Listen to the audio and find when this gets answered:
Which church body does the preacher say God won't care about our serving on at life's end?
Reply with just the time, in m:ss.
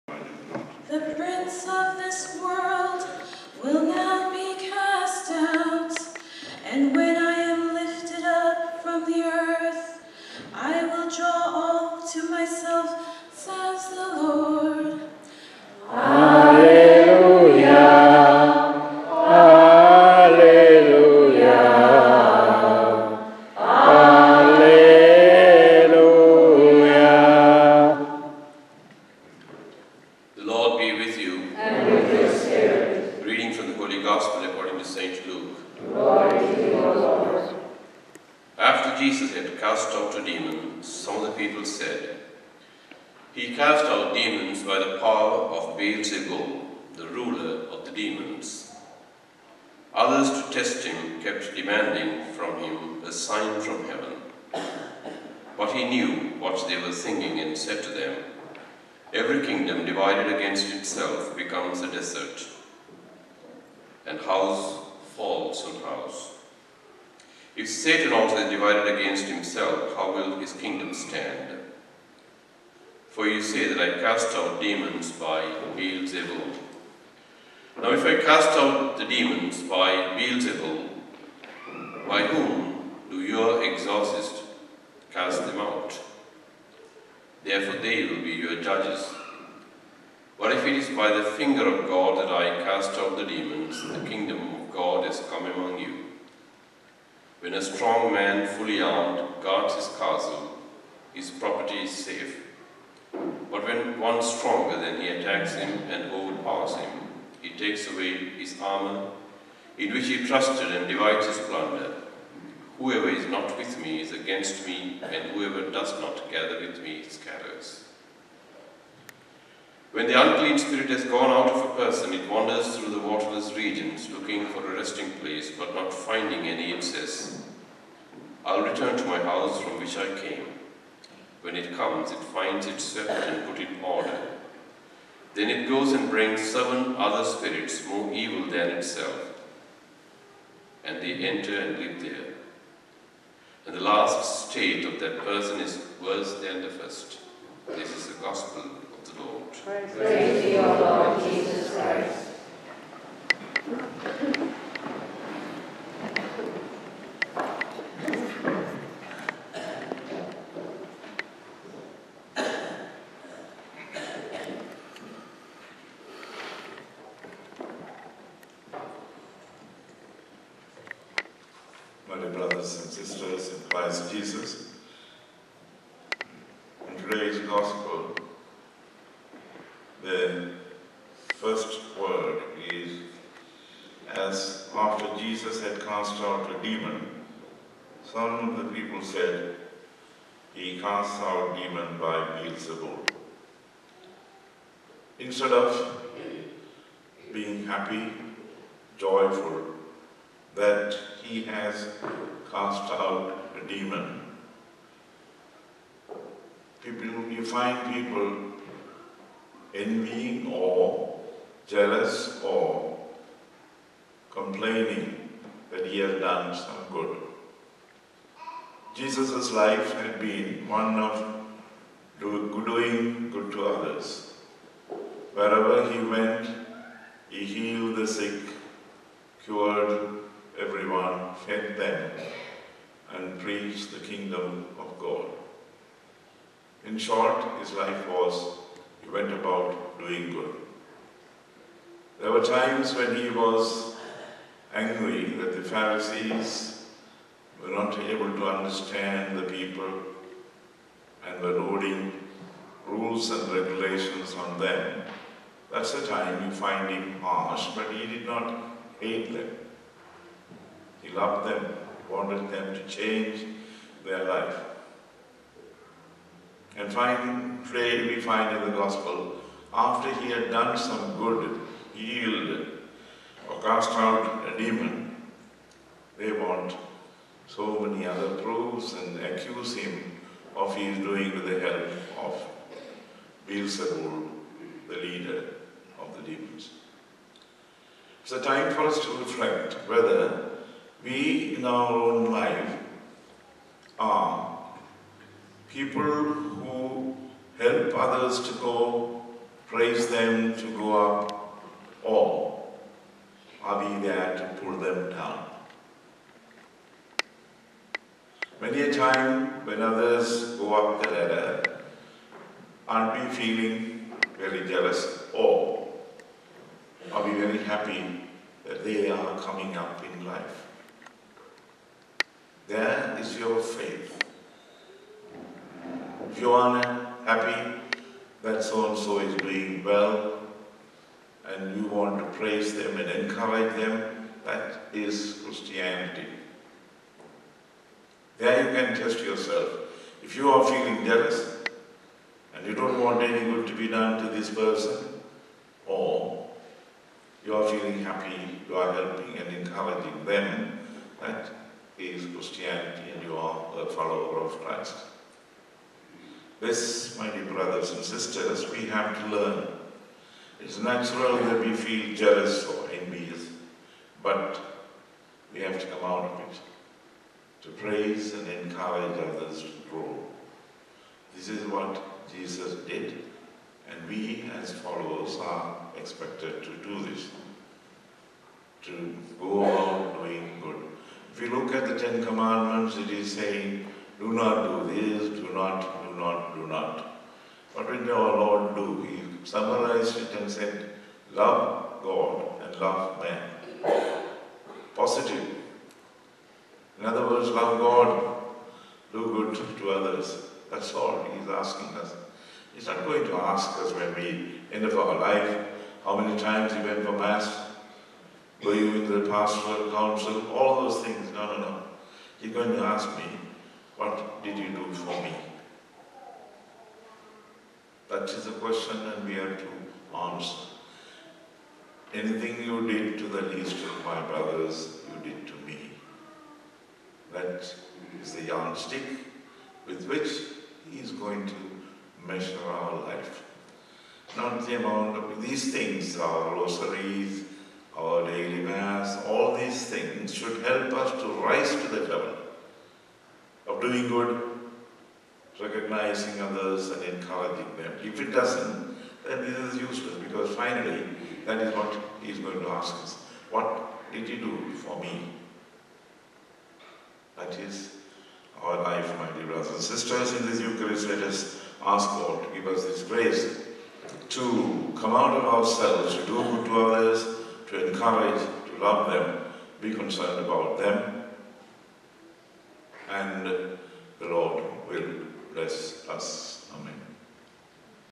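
6:49.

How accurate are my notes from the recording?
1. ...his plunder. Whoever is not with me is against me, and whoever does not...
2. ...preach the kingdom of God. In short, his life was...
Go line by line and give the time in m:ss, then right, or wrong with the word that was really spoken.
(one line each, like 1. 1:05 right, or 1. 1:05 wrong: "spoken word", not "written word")
1. 1:51 right
2. 3:53 right.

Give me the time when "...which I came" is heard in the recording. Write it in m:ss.
2:09.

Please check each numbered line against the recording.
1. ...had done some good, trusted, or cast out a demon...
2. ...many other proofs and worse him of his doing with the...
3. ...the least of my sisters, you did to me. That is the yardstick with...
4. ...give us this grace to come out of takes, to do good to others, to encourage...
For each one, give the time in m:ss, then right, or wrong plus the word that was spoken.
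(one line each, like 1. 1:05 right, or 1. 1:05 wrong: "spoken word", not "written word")
1. 4:30 wrong: "healed", not "trusted"
2. 4:37 wrong: "accuse", not "worse"
3. 7:03 wrong: "brothers", not "sisters"
4. 7:42 wrong: "ourselves", not "takes".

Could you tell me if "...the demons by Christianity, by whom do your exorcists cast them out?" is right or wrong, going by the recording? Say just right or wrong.
wrong.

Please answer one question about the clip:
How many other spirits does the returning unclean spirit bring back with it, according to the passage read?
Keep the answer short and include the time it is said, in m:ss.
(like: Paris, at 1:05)
7, at 2:16.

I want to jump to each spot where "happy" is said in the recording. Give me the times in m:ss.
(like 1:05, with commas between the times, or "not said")
3:17, 5:17, 5:27, 5:48.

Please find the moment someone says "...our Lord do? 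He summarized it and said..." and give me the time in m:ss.
6:28.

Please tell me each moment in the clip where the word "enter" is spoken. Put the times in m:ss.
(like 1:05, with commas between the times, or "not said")
2:21.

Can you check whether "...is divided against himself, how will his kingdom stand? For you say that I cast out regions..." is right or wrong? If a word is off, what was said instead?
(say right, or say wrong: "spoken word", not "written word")
wrong: "demons", not "regions".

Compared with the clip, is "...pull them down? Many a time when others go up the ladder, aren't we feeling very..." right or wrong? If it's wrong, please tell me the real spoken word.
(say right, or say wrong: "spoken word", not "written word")
right.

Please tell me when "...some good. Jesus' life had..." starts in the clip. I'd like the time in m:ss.
3:36.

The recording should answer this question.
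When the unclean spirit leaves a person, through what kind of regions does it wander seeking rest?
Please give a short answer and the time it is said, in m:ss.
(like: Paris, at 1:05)
waterless regions, at 2:03.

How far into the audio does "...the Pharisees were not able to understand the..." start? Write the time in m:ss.
4:05.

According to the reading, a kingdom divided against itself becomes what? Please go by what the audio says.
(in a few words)
a desert.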